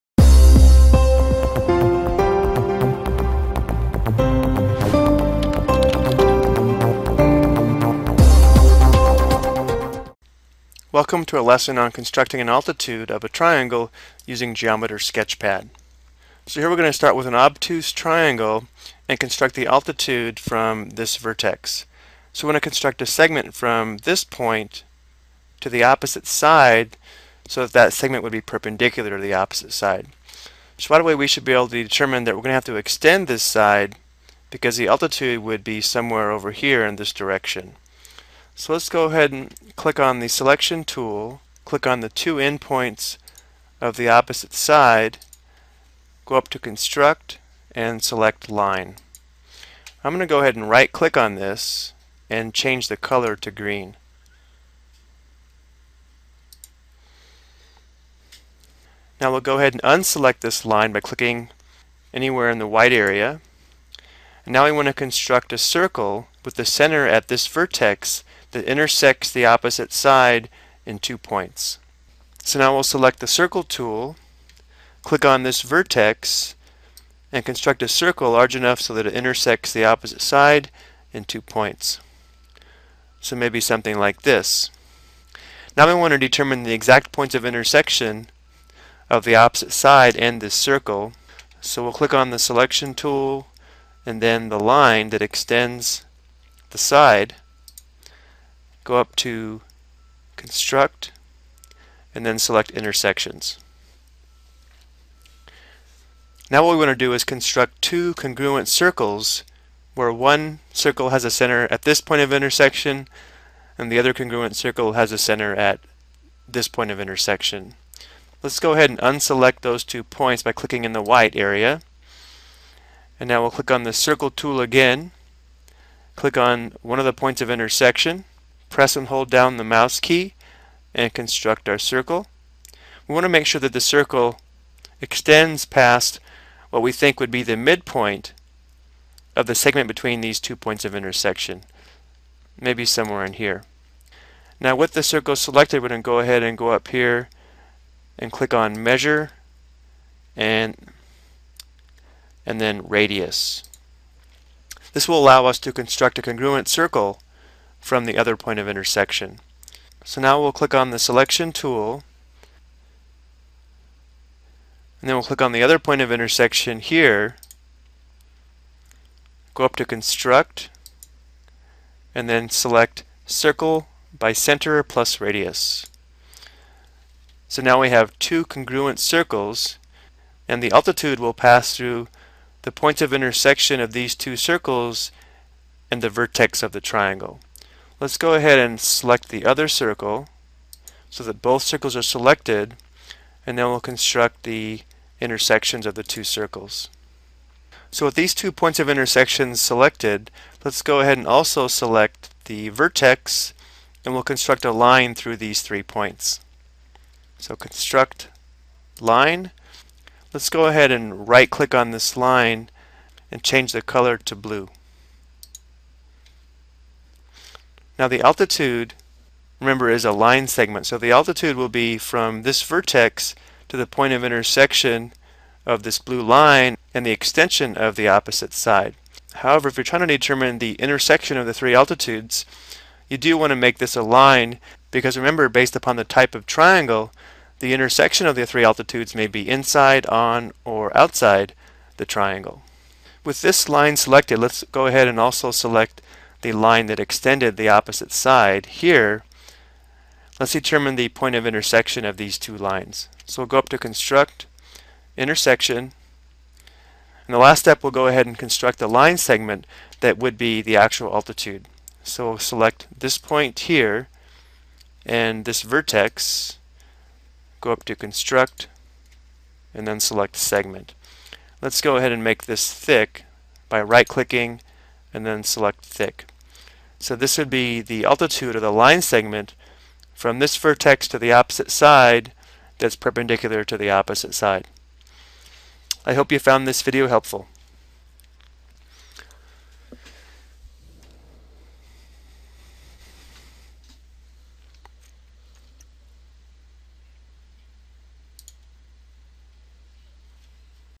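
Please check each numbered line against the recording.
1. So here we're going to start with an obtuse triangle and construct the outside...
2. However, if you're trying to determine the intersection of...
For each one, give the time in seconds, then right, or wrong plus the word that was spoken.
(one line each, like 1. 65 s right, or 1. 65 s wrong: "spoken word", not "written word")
1. 16 s wrong: "altitude", not "outside"
2. 229 s right.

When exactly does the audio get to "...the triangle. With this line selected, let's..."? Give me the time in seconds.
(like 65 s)
241 s.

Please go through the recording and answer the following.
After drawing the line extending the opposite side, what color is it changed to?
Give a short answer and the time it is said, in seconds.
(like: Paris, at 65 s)
Green, at 53 s.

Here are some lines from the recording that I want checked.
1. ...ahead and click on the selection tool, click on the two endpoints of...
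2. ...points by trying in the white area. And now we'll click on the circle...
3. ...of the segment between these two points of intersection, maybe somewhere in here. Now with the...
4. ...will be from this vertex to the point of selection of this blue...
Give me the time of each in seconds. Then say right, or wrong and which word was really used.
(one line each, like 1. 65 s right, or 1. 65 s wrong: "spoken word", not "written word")
1. 39 s right
2. 120 s wrong: "clicking", not "trying"
3. 139 s right
4. 221 s wrong: "intersection", not "selection".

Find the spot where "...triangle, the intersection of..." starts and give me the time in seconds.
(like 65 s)
236 s.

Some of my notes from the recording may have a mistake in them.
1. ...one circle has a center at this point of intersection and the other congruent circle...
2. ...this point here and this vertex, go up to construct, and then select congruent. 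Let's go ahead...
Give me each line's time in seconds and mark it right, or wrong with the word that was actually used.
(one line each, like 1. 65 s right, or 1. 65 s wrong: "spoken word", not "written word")
1. 110 s right
2. 262 s wrong: "segment", not "congruent".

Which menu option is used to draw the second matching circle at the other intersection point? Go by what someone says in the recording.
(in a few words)
Circle by center plus radius.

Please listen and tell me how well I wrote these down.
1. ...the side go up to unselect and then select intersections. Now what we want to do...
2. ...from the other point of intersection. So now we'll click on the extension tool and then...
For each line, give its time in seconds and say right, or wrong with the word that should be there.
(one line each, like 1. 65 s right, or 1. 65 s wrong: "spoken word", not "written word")
1. 96 s wrong: "construct", not "unselect"
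2. 157 s wrong: "selection", not "extension".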